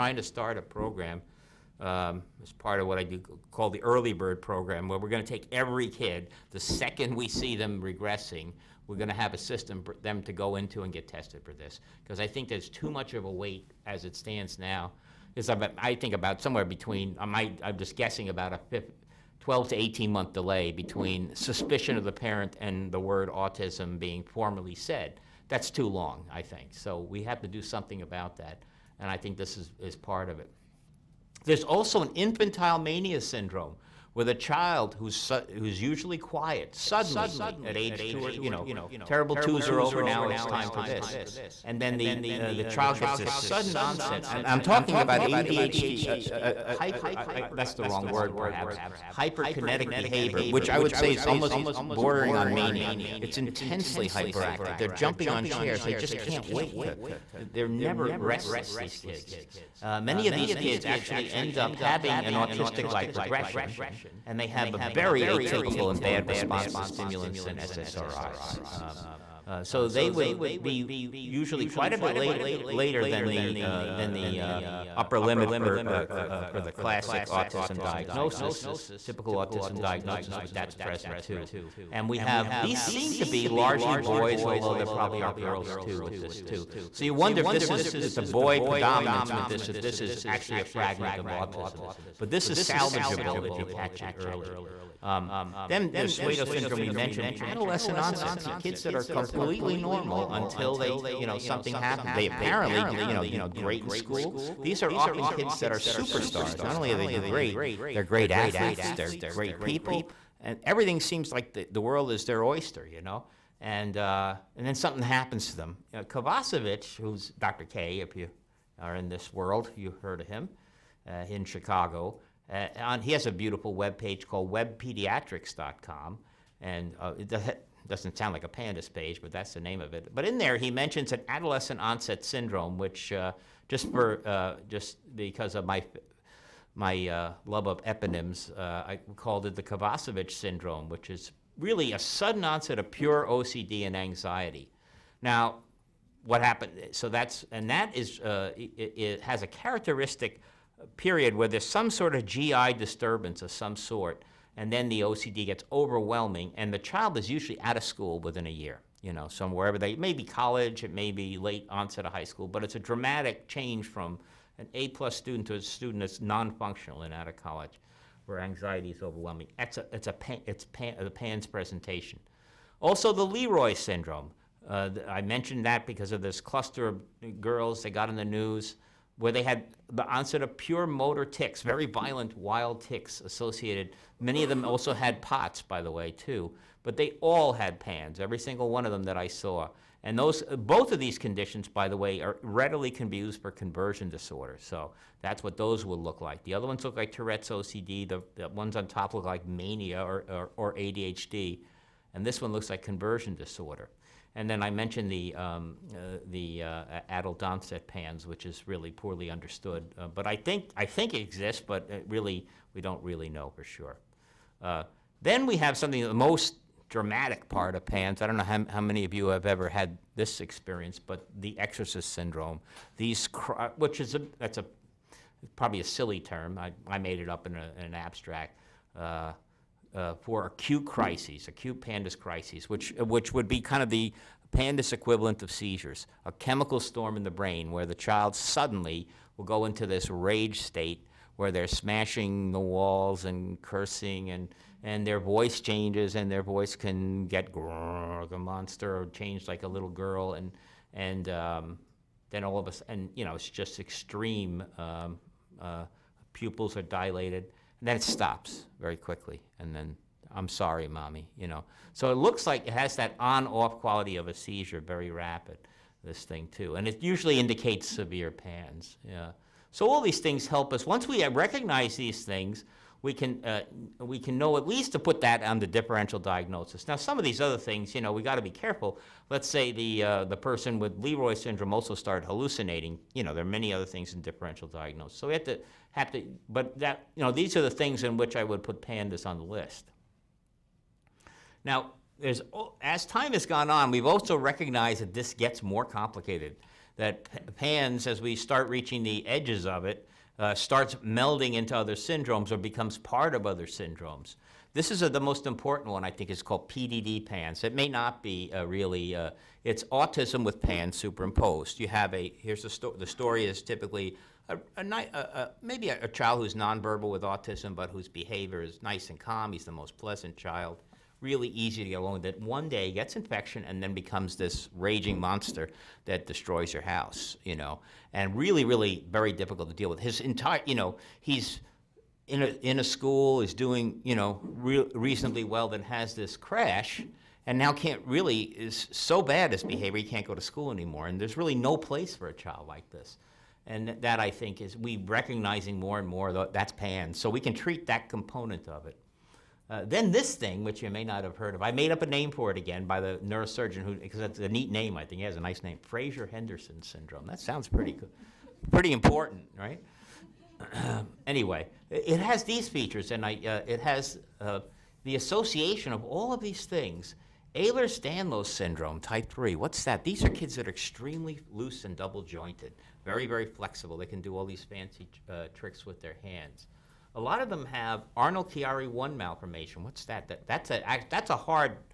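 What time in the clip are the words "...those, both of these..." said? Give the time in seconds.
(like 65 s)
190 s.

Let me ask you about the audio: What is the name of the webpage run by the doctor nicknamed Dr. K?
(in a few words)
webpediatrics.com.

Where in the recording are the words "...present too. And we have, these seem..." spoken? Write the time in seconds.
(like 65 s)
80 s.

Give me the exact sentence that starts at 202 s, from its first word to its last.
And this one looks like conversion disorder.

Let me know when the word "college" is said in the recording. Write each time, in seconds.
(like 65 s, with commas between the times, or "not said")
160 s, 167 s.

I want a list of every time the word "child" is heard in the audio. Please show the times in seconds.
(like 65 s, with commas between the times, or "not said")
34 s, 42 s, 156 s, 237 s, 316 s, 320 s, 342 s.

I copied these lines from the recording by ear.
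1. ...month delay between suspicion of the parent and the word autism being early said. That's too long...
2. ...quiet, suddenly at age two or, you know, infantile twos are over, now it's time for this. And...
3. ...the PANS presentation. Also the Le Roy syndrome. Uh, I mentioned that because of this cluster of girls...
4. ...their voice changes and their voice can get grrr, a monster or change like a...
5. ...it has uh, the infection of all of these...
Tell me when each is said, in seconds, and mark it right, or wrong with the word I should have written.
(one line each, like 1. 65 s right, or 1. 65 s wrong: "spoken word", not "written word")
1. 20 s wrong: "formally", not "early"
2. 36 s wrong: "terrible", not "infantile"
3. 171 s right
4. 245 s right
5. 363 s wrong: "association", not "infection".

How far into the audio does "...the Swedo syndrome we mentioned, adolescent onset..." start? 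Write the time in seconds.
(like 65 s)
95 s.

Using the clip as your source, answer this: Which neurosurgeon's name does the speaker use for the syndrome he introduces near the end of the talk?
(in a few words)
Fraser Henderson.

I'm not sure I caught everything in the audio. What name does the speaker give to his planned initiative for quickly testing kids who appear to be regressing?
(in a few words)
Early bird program.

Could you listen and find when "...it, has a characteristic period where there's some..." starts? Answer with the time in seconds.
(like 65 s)
148 s.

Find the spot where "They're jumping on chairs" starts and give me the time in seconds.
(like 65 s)
54 s.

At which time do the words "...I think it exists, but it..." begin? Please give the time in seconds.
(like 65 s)
210 s.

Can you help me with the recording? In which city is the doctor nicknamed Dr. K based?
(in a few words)
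Chicago.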